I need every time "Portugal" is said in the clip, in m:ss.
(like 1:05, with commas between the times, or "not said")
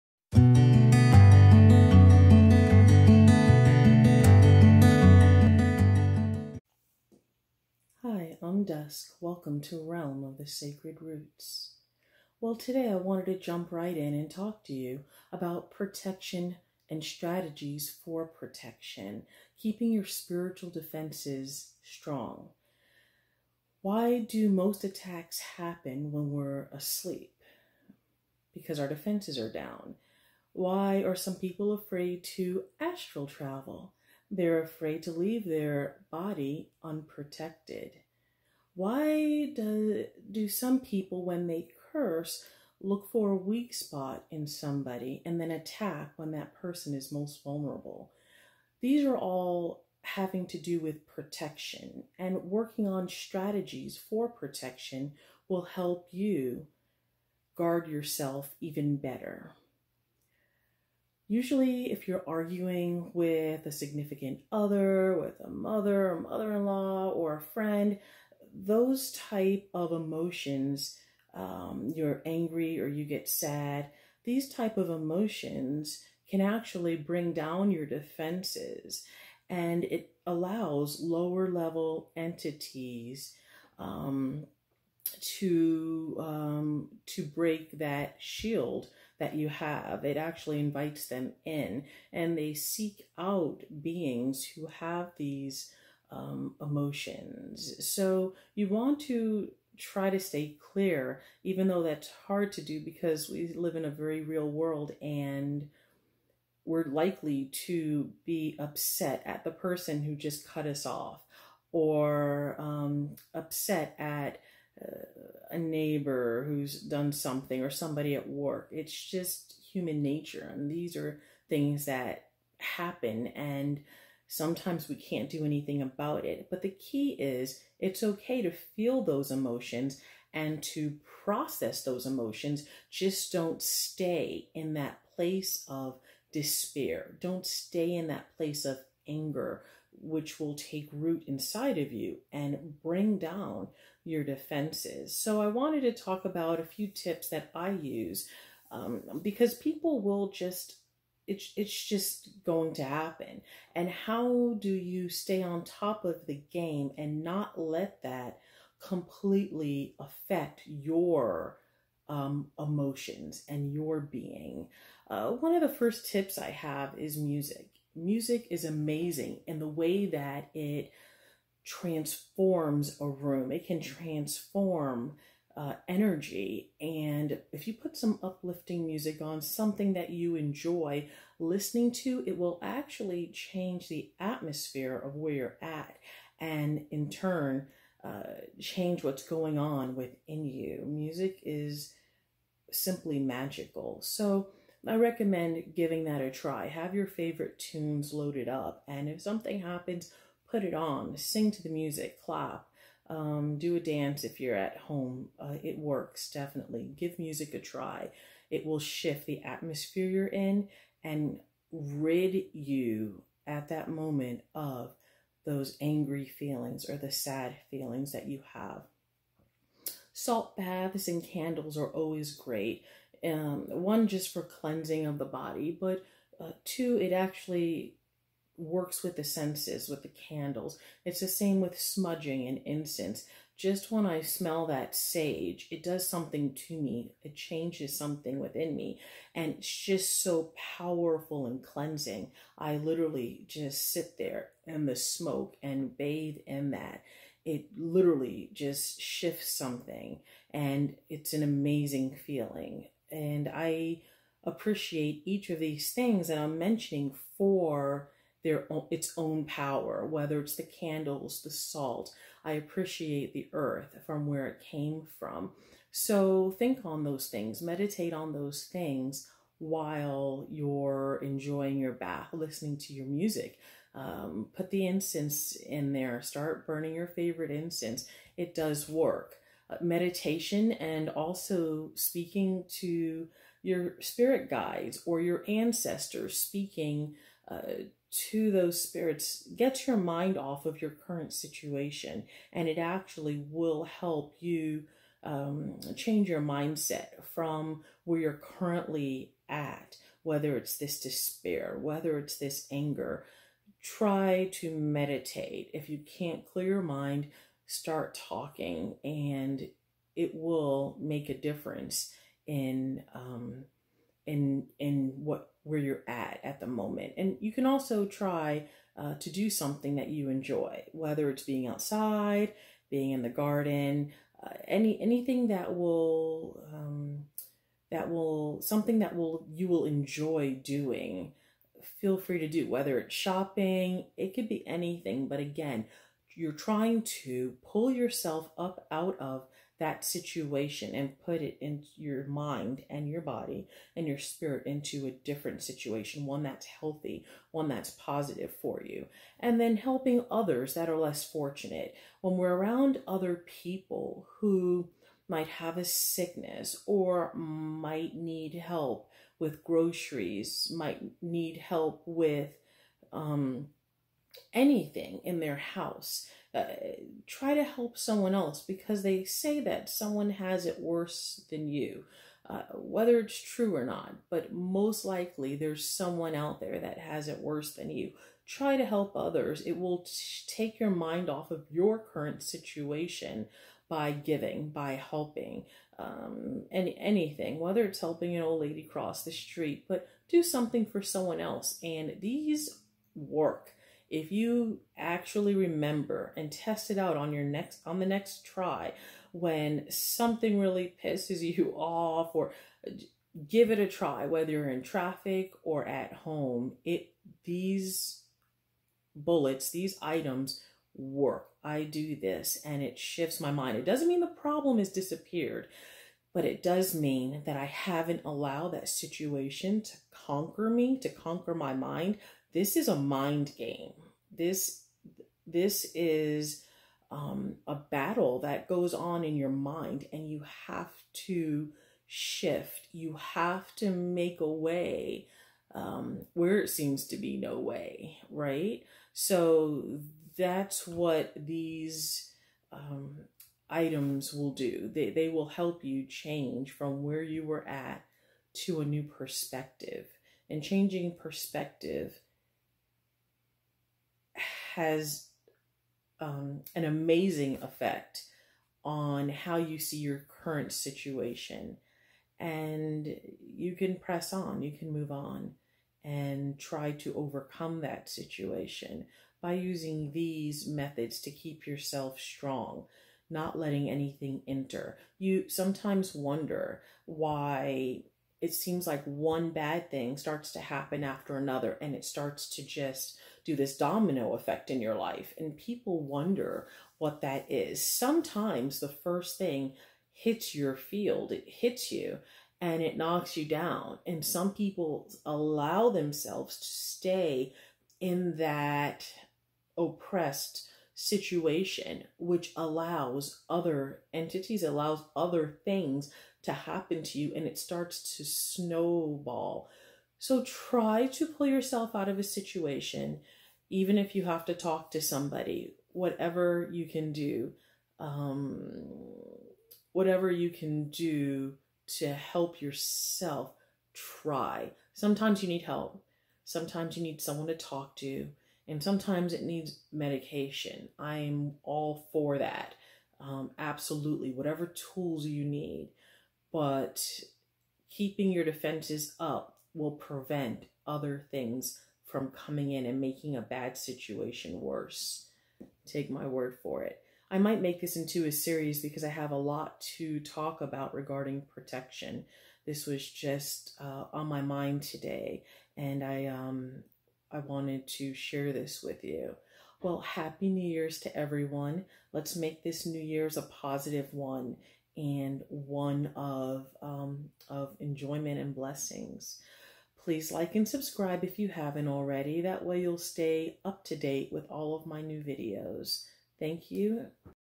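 not said.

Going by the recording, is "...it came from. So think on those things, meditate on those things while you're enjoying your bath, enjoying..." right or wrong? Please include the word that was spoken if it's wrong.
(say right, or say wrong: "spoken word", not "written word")
wrong: "listening", not "enjoying".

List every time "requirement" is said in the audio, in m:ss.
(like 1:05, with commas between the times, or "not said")
not said.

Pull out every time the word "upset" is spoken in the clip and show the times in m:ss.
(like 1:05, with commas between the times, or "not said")
1:48, 1:53.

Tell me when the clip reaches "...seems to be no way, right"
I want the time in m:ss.
7:16.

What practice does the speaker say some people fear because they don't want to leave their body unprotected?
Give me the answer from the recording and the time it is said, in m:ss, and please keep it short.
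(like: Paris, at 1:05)
Astral travel, at 0:32.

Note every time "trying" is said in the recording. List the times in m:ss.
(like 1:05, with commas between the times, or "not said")
5:36.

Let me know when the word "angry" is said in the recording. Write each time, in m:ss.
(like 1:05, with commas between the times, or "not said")
1:12, 3:35.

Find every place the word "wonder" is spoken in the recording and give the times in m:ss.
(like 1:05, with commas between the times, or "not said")
7:56, 8:06.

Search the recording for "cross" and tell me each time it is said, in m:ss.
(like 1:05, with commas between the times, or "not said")
6:28.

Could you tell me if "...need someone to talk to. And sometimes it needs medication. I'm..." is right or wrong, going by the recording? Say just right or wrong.
right.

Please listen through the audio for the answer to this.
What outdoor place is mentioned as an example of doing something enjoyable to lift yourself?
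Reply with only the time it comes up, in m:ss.
5:23.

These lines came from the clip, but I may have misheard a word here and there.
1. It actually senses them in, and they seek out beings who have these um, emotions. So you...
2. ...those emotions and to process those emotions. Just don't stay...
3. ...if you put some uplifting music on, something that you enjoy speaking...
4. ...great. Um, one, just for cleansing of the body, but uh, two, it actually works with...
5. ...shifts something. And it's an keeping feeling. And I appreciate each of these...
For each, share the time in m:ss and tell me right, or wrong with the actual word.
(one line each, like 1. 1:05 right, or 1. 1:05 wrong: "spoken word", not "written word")
1. 1:30 wrong: "invites", not "senses"
2. 2:09 right
3. 2:57 wrong: "listening", not "speaking"
4. 3:42 right
5. 4:08 wrong: "amazing", not "keeping".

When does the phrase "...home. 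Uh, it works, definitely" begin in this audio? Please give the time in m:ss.
3:24.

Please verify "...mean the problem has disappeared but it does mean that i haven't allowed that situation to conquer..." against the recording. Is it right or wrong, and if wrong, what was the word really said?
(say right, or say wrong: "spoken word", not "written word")
right.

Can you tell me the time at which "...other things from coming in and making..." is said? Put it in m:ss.
9:00.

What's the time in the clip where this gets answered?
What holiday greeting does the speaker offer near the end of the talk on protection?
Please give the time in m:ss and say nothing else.
9:20.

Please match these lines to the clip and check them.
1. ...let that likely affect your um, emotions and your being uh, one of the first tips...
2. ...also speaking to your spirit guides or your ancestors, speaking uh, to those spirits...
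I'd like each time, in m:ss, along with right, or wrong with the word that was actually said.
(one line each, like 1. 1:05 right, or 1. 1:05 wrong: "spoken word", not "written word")
1. 2:37 wrong: "completely", not "likely"
2. 4:41 right.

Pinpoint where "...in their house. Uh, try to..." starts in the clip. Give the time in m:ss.
6:05.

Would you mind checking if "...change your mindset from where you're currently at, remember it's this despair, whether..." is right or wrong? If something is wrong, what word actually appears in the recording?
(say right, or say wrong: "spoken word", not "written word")
wrong: "whether", not "remember".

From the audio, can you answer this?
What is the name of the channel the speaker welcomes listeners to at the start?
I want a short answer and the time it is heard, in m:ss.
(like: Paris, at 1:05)
Realm of the Sacred Roots, at 0:09.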